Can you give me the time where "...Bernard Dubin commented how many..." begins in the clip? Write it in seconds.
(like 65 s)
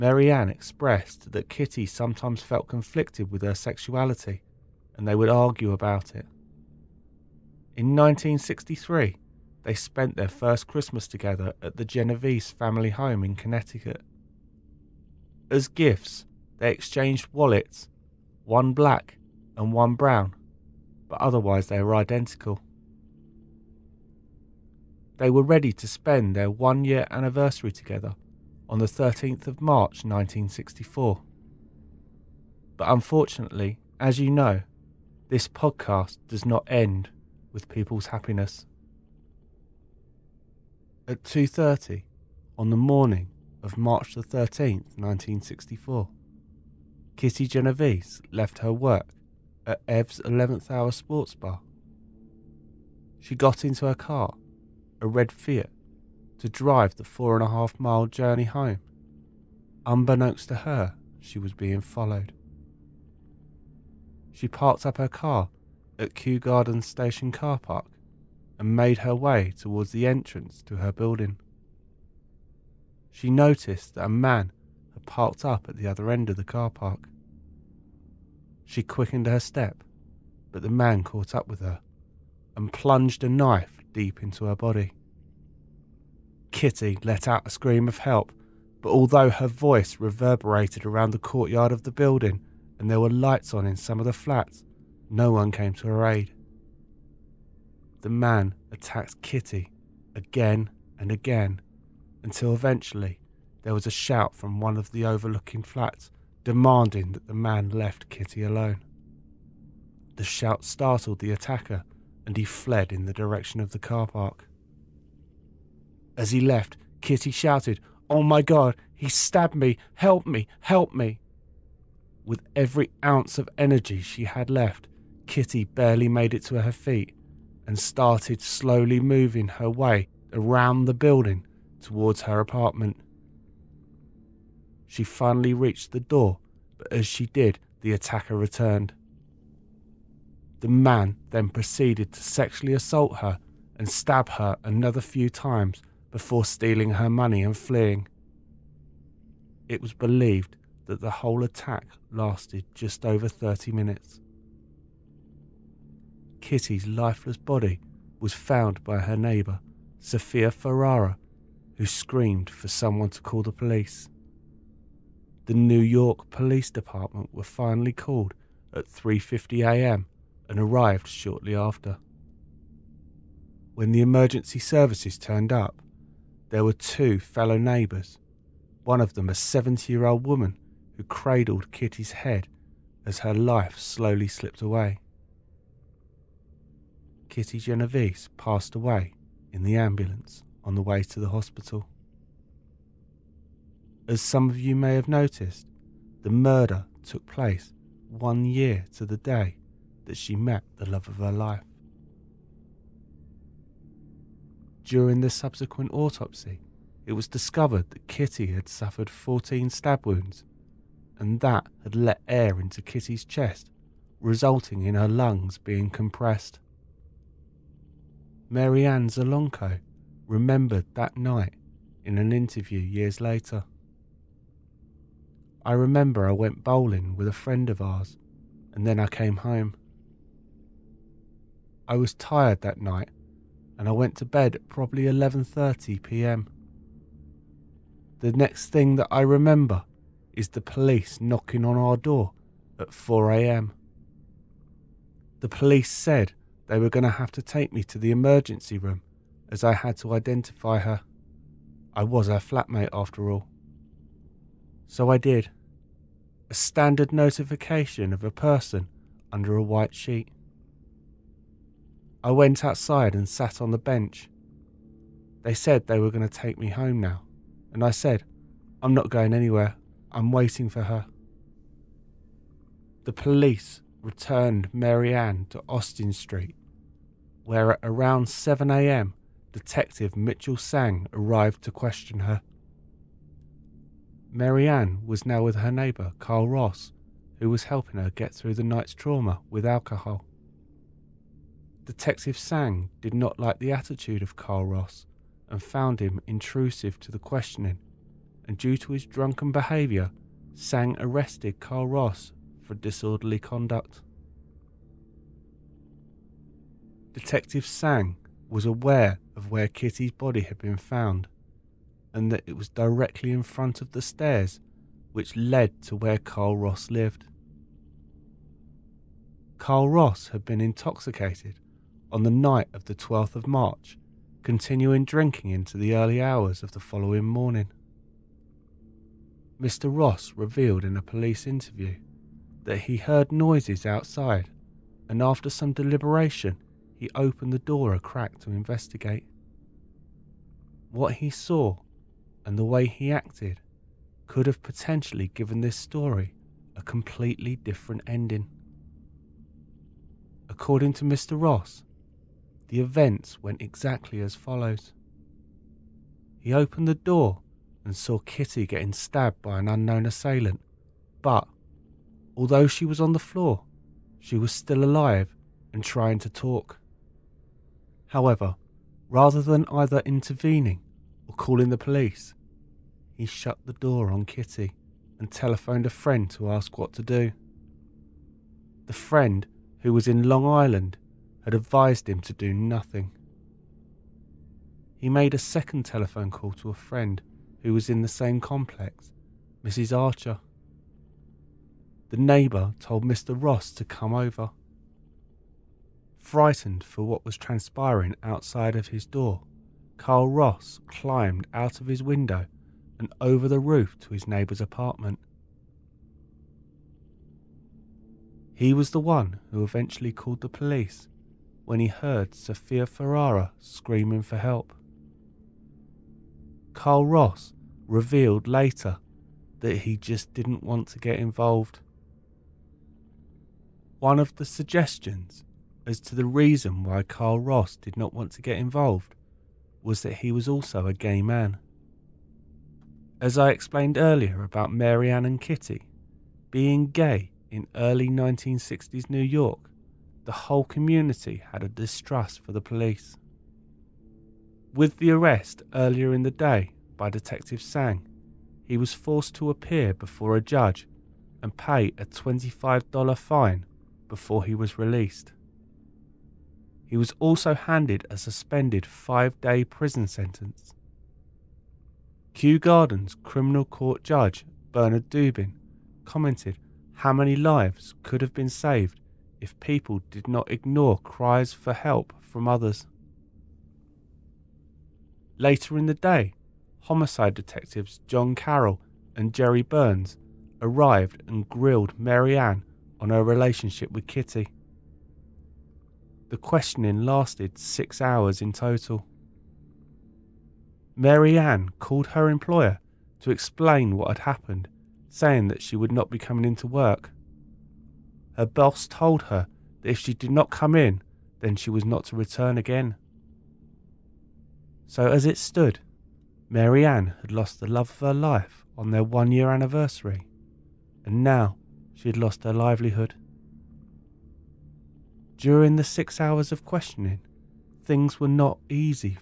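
464 s.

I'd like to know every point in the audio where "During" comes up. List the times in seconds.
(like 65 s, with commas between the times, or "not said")
204 s, 515 s.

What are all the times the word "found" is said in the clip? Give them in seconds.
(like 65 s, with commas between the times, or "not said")
158 s, 295 s, 310 s.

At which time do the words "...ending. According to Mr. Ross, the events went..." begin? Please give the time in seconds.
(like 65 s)
348 s.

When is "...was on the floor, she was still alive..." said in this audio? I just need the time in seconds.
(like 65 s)
362 s.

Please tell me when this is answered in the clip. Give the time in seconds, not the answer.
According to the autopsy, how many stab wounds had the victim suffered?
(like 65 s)
209 s.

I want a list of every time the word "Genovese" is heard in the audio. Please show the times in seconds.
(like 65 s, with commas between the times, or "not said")
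11 s, 47 s, 187 s.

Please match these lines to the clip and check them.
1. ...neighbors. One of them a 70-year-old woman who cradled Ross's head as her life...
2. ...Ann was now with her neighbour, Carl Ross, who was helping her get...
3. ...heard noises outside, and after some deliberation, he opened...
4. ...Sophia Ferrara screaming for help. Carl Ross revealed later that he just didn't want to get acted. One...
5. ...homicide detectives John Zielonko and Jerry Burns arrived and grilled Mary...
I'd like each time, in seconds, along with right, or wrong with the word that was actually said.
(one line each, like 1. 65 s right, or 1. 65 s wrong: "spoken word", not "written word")
1. 177 s wrong: "Kitty", not "Ross"
2. 284 s right
3. 332 s right
4. 412 s wrong: "involved", not "acted"
5. 476 s wrong: "Carroll", not "Zielonko".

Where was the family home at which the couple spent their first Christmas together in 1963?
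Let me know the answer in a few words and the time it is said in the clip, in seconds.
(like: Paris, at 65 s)
Connecticut, at 13 s.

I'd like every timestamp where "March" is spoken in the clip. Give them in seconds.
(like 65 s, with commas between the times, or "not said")
29 s, 43 s, 323 s.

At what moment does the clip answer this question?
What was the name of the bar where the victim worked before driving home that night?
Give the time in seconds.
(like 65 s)
49 s.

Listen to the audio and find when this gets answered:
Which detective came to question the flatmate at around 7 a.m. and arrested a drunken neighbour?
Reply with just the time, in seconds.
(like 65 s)
280 s.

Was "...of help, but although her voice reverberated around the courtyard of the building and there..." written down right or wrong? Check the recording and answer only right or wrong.
right.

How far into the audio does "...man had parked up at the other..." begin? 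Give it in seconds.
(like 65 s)
74 s.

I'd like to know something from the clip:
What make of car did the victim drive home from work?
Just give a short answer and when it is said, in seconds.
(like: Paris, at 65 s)
Fiat, at 55 s.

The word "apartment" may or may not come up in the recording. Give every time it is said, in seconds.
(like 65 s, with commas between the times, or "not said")
132 s, 404 s.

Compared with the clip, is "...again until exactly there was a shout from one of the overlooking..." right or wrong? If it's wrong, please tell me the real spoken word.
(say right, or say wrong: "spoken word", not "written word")
wrong: "eventually", not "exactly".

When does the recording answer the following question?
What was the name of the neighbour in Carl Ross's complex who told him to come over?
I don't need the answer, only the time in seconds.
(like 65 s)
389 s.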